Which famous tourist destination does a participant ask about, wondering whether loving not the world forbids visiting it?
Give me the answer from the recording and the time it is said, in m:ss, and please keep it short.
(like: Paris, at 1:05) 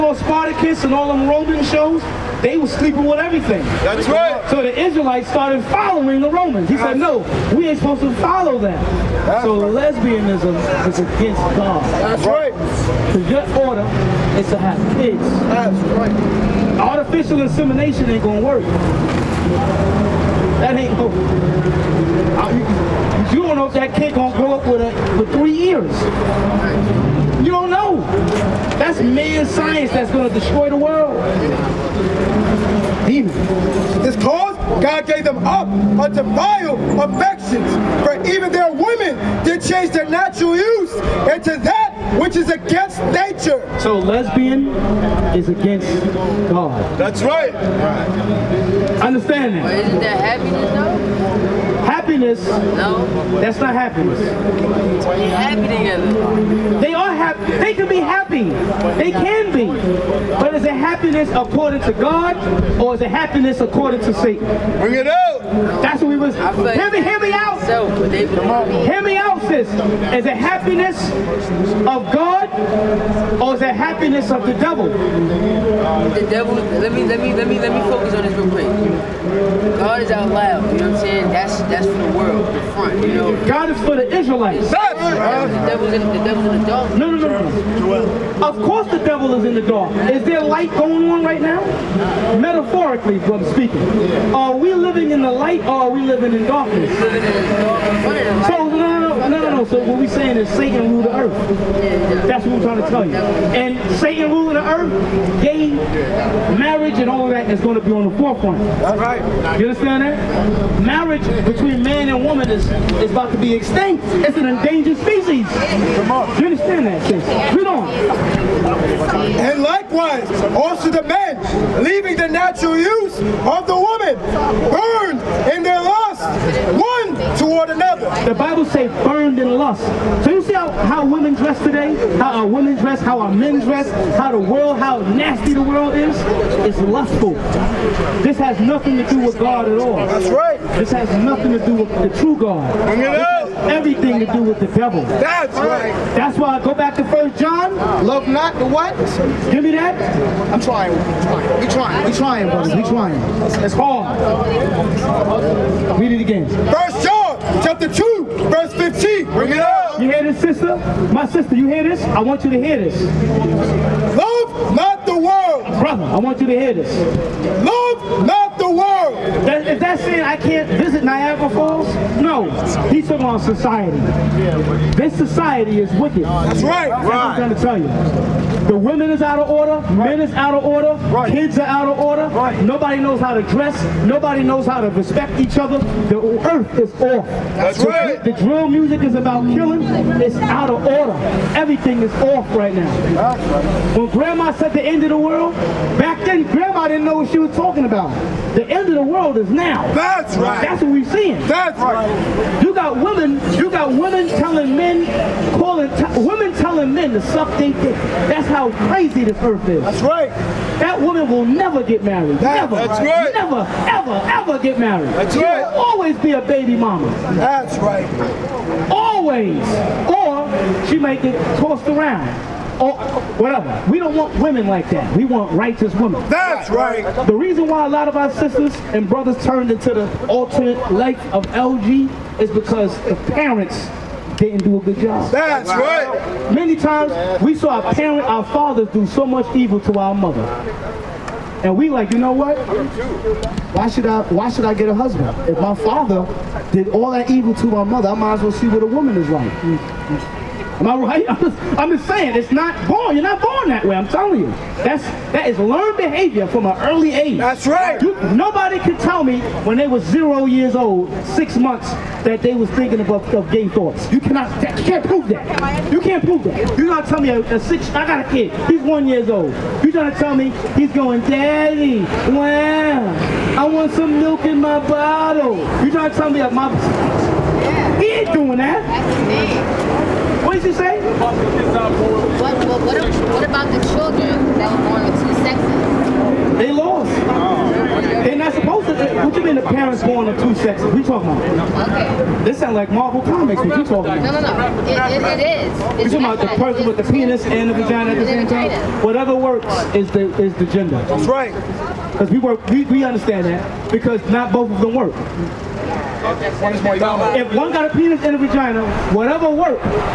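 Niagara Falls, at 2:51.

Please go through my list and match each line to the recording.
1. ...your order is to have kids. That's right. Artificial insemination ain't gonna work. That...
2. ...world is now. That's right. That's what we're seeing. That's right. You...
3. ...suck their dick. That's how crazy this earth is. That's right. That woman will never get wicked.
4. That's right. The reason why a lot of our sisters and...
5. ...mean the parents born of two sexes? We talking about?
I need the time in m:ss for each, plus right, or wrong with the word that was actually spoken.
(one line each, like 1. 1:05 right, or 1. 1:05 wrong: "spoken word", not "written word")
1. 0:13 right
2. 3:19 right
3. 3:27 wrong: "married", not "wicked"
4. 3:46 right
5. 4:49 right.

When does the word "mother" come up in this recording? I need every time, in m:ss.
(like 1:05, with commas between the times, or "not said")
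4:00, 4:07.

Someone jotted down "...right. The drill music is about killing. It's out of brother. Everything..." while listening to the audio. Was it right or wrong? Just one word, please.
wrong.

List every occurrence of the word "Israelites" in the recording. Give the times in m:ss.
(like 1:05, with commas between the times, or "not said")
0:04, 1:24.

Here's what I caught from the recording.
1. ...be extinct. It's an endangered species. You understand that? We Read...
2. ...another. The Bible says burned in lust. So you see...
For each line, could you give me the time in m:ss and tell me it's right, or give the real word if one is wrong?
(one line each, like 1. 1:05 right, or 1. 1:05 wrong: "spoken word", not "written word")
1. 1:53 right
2. 2:07 right.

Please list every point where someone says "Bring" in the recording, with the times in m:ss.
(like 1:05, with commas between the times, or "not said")
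1:04, 2:22, 2:39.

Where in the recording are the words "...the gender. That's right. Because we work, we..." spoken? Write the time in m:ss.
5:00.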